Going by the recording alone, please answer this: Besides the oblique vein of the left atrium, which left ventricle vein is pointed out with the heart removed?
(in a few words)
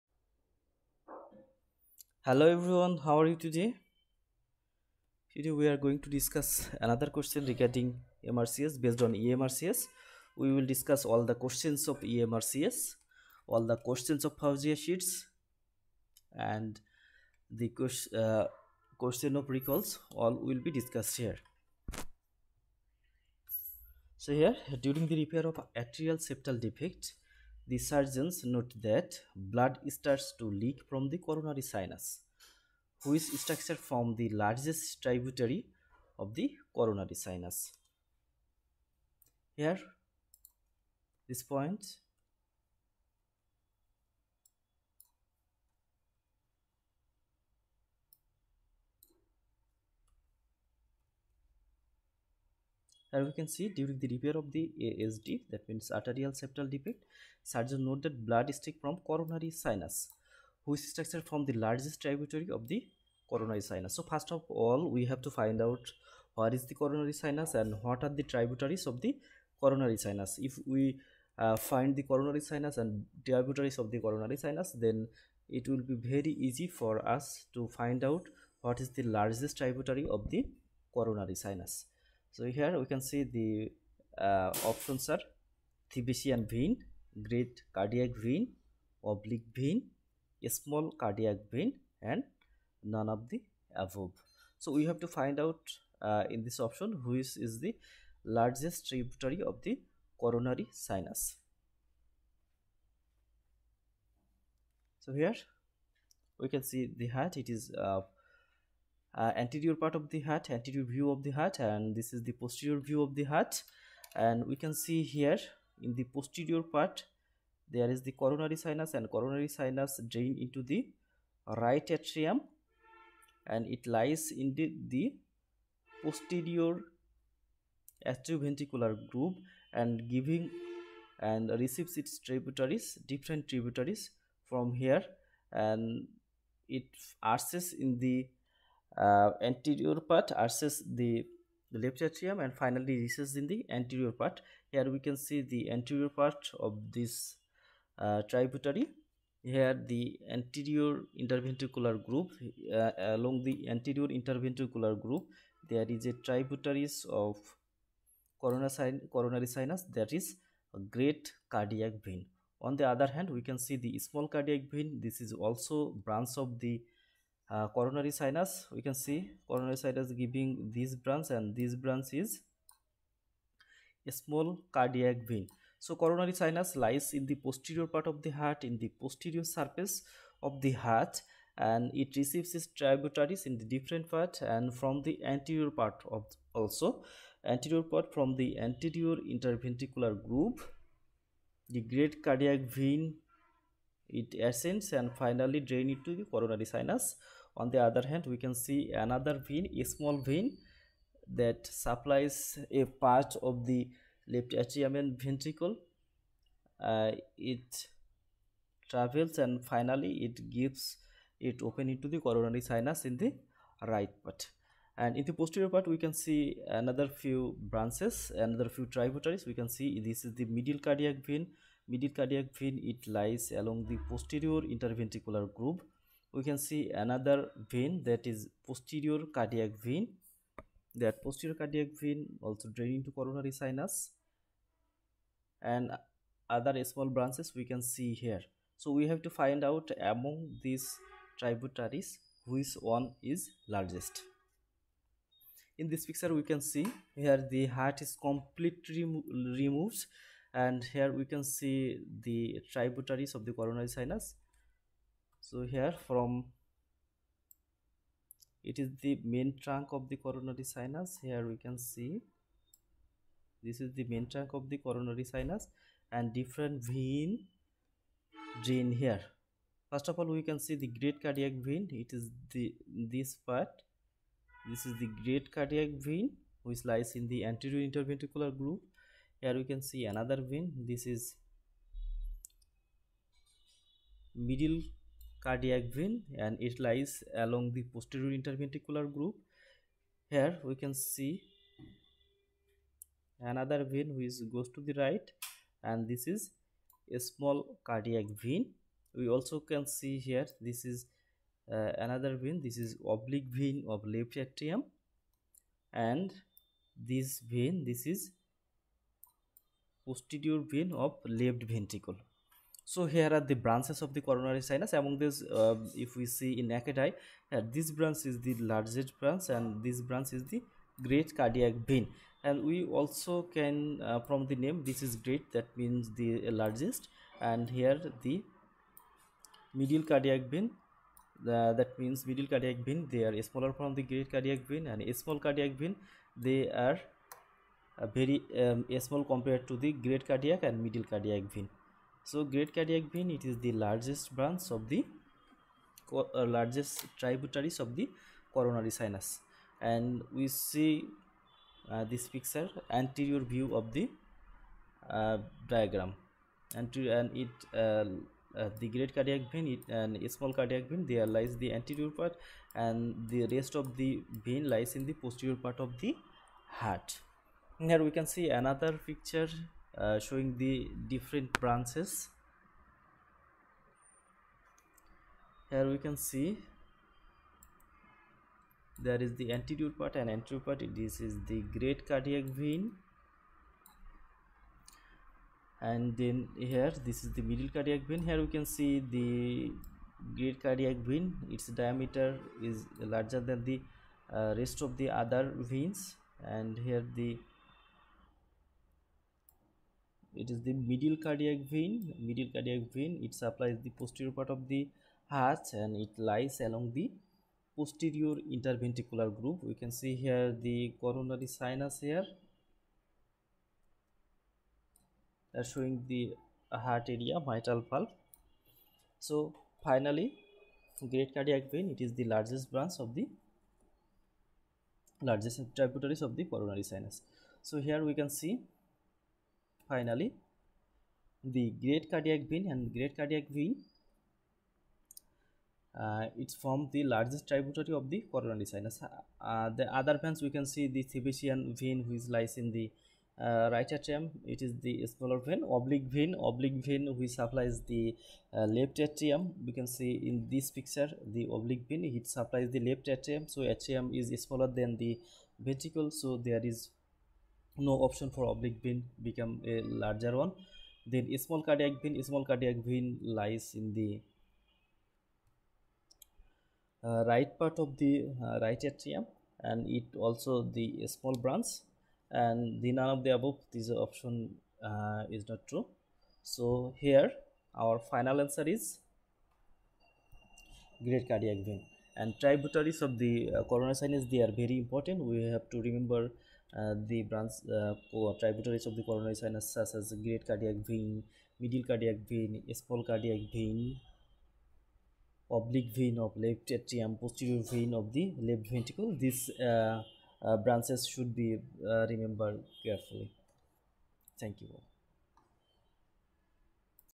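Posterior vein of left ventricle.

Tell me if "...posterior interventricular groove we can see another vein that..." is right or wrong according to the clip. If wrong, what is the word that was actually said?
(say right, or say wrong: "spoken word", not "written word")
right.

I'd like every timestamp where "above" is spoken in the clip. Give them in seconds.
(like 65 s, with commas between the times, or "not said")
93 s, 473 s.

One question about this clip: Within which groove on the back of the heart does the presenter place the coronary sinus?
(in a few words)
Posterior atrioventricular groove.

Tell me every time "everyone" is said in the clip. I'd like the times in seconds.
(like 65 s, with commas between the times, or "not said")
2 s.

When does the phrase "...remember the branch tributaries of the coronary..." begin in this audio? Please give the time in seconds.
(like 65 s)
485 s.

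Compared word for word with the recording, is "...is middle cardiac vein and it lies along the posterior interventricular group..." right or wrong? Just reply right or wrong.
right.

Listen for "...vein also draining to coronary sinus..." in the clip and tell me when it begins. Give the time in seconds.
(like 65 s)
232 s.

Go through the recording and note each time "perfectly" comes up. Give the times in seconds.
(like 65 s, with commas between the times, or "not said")
not said.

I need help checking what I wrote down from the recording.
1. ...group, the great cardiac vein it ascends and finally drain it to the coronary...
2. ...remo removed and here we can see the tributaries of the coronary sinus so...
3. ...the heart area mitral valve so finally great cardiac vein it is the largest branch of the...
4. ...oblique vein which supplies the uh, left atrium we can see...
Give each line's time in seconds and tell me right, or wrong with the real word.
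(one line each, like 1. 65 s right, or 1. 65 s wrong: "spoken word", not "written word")
1. 190 s right
2. 249 s right
3. 416 s right
4. 446 s right.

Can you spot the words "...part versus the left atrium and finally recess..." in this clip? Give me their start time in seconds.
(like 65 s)
140 s.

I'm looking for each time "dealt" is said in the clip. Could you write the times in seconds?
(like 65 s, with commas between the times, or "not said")
not said.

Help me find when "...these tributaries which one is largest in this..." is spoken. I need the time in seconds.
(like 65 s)
240 s.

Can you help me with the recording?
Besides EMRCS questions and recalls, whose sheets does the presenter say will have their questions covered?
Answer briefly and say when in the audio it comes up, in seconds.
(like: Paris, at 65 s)
Fawzia, at 14 s.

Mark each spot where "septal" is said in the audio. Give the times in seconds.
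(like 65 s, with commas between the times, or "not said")
26 s, 56 s.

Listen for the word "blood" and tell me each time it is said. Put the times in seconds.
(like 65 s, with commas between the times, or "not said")
29 s, 58 s.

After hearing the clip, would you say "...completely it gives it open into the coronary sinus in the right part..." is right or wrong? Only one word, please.
wrong.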